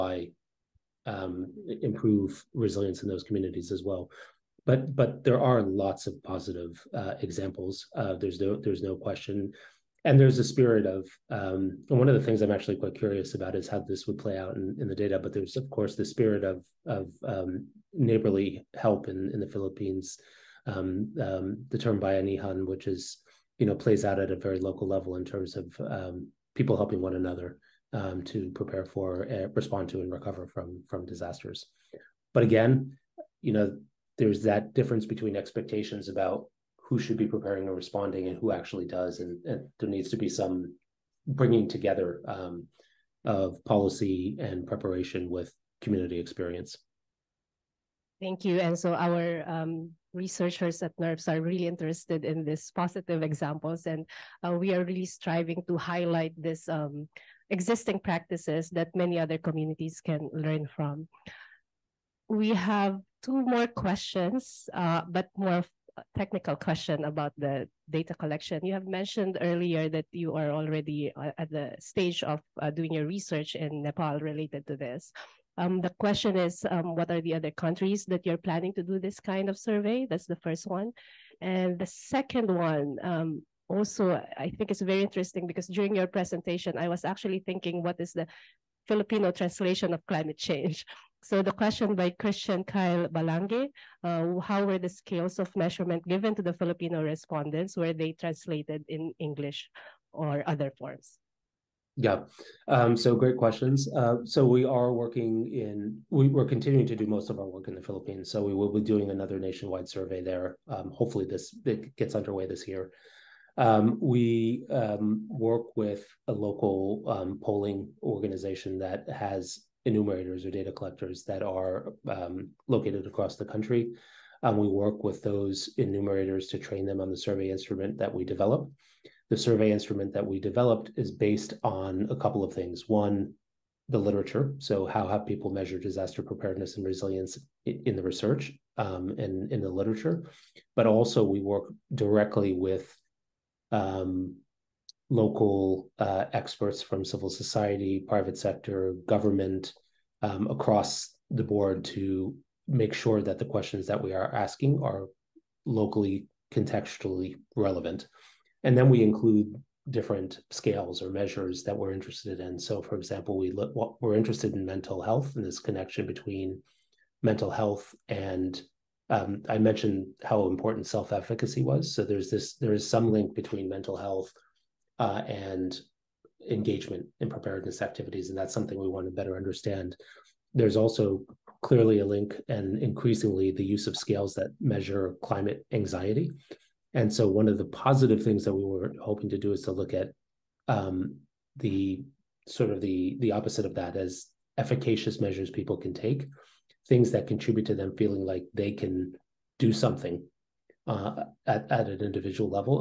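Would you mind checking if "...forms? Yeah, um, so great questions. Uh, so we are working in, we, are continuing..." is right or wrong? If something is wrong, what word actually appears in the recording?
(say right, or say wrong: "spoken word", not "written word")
right.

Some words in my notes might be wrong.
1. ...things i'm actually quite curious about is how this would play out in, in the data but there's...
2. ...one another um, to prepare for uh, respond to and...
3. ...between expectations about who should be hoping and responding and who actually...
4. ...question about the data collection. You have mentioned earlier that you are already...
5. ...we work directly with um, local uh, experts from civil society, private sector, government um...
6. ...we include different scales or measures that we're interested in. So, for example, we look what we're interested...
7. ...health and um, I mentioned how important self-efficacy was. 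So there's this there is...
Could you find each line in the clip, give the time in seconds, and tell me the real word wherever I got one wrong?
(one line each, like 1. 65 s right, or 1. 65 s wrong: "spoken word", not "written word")
1. 12 s right
2. 26 s right
3. 35 s wrong: "preparing", not "hoping"
4. 66 s right
5. 141 s right
6. 158 s right
7. 167 s right.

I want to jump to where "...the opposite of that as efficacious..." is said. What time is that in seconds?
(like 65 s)
193 s.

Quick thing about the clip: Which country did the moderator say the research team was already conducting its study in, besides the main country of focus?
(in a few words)
Nepal.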